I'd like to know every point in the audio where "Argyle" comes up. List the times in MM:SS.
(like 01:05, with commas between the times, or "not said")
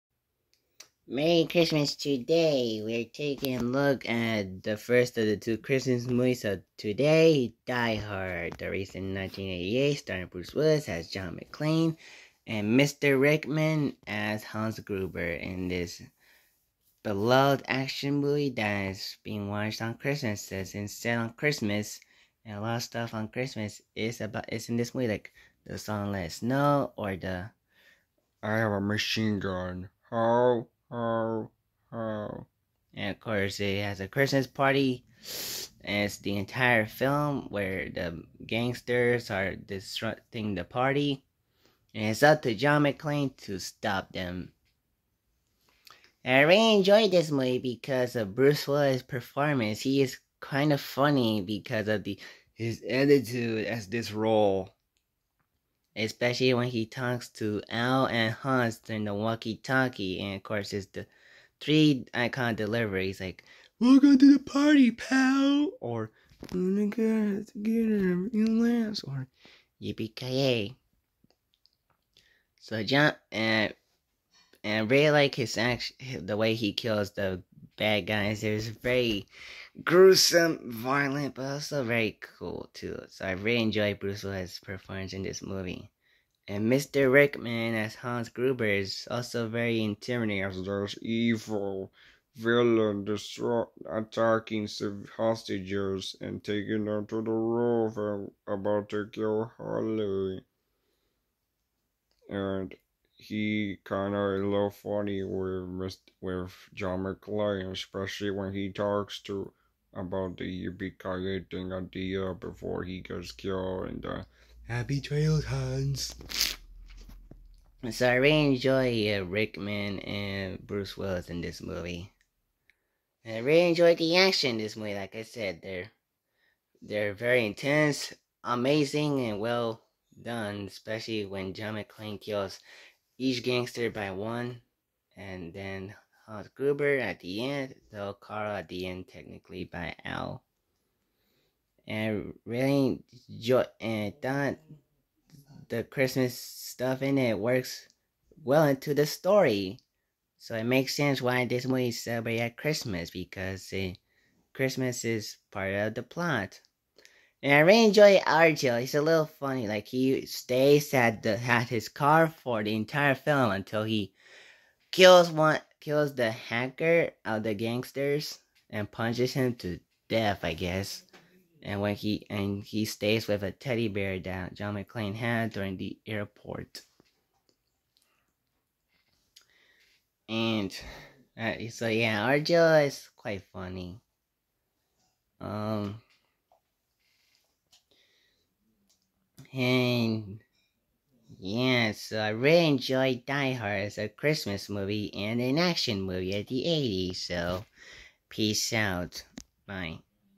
02:38, 03:02.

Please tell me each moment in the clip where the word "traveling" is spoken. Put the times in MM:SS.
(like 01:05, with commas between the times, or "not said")
not said.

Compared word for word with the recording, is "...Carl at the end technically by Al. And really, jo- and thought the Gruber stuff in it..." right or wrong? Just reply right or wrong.
wrong.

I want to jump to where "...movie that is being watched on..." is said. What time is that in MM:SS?
00:18.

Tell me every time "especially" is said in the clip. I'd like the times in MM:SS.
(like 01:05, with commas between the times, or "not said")
00:55, 01:47, 02:10.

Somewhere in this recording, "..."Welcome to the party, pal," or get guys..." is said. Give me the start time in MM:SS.
01:03.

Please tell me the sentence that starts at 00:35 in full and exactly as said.
And it's the entire film where the gangsters are disrupting the party.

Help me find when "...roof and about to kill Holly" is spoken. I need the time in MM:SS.
01:37.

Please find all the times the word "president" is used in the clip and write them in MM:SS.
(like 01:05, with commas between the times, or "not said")
not said.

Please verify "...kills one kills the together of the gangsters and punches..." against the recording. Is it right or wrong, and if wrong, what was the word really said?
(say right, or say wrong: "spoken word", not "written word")
wrong: "hacker", not "together".